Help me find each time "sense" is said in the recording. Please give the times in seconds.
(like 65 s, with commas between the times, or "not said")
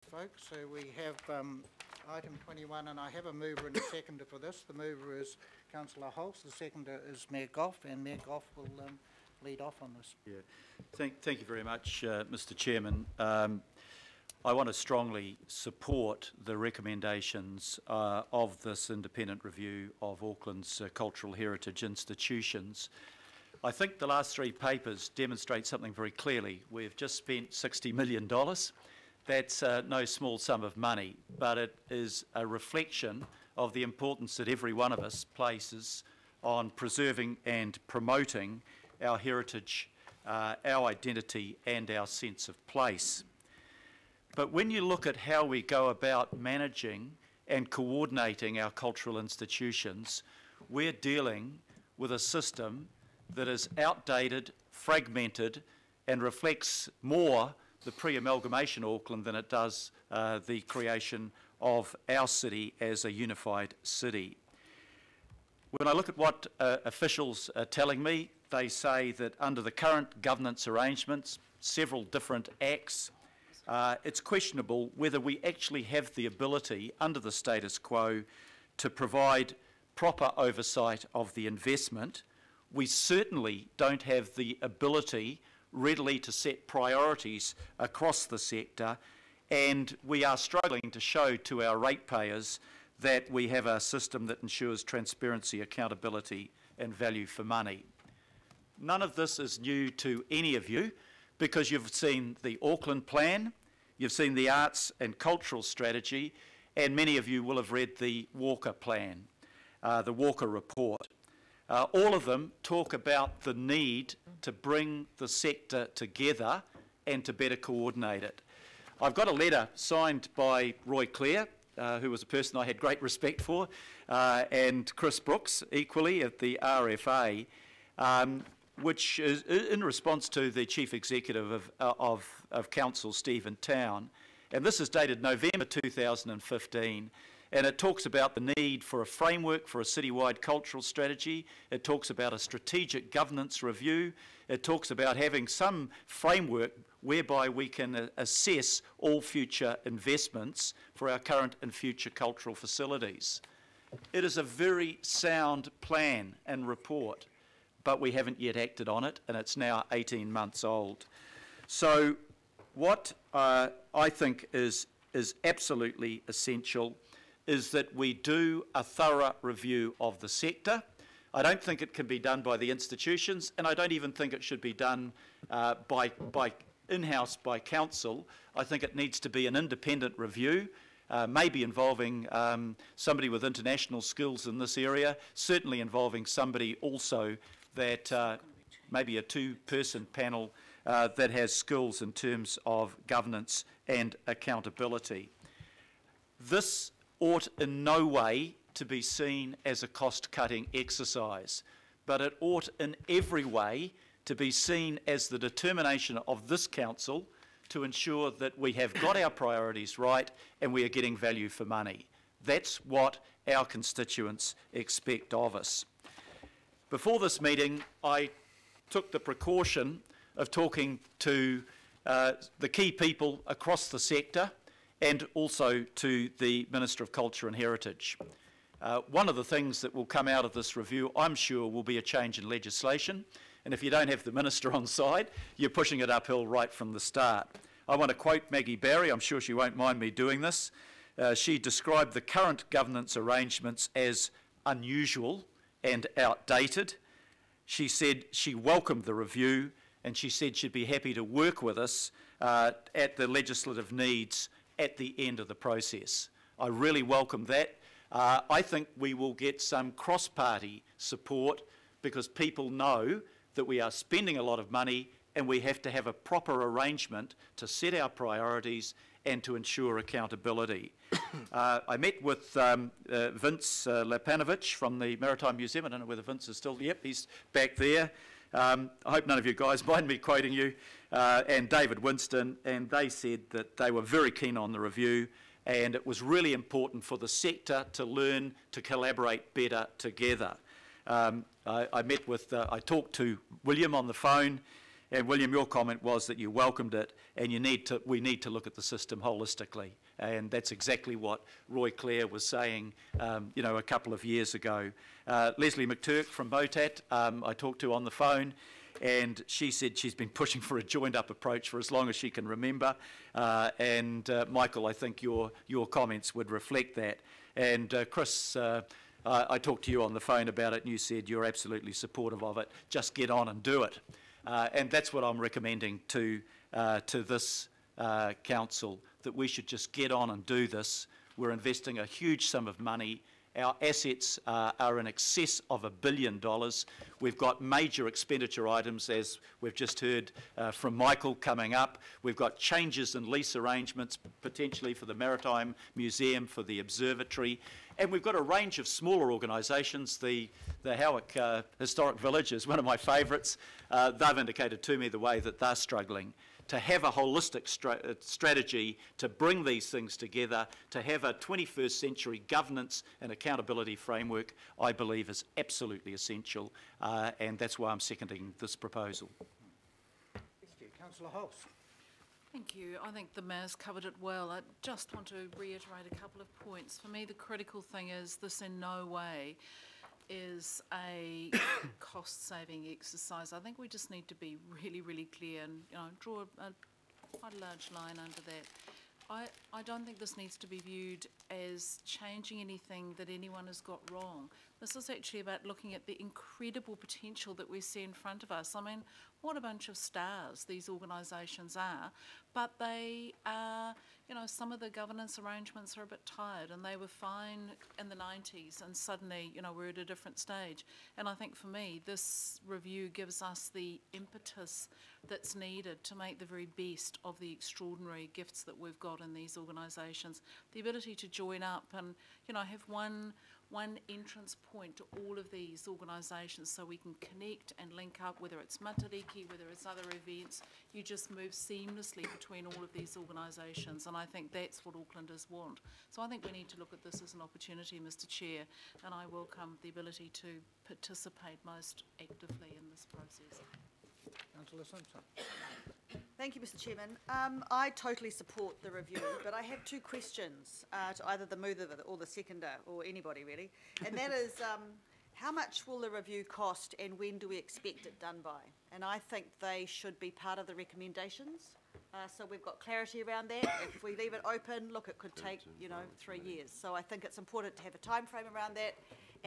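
42 s.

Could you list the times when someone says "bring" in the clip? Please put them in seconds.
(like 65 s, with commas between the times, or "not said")
114 s, 359 s.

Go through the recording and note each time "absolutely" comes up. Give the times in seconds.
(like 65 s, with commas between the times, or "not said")
165 s, 321 s, 365 s.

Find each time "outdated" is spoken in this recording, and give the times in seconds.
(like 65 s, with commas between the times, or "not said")
53 s, 246 s.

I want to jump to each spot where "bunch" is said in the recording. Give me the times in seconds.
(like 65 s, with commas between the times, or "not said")
399 s.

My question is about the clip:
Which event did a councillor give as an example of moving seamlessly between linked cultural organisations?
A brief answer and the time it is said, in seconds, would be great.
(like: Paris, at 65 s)
Matariki, at 428 s.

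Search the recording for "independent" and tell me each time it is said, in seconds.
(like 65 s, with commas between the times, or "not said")
18 s, 179 s.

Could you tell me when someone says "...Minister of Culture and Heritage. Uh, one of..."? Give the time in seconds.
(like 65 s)
226 s.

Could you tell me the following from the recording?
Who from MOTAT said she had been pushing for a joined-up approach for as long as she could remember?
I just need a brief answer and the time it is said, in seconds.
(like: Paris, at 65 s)
Lesley McTurk, at 305 s.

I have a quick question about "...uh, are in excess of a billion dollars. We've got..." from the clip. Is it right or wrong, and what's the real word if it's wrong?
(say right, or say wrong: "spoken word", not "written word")
right.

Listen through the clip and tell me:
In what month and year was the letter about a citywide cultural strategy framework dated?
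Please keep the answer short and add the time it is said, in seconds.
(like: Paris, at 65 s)
November 2015, at 135 s.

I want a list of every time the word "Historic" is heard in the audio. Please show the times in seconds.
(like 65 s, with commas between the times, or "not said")
351 s.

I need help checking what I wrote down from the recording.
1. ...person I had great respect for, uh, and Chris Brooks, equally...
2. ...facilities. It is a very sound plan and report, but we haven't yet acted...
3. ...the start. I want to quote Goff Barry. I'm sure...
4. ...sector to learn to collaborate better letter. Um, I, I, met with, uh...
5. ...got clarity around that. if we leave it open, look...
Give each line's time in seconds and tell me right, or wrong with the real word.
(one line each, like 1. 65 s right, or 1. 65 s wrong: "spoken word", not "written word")
1. 122 s right
2. 152 s right
3. 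236 s wrong: "Maggie", not "Goff"
4. 287 s wrong: "together", not "letter"
5. 462 s right.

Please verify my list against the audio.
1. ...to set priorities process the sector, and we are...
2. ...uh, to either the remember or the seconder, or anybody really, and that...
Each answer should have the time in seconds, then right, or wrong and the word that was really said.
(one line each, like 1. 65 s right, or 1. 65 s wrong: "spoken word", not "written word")
1. 86 s wrong: "across", not "process"
2. 450 s wrong: "mover", not "remember".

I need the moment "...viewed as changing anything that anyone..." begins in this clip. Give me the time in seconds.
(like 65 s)
390 s.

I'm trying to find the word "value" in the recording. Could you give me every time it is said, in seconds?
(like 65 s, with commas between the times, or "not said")
96 s, 211 s.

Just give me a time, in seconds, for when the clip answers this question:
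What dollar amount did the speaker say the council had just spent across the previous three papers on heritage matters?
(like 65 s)
27 s.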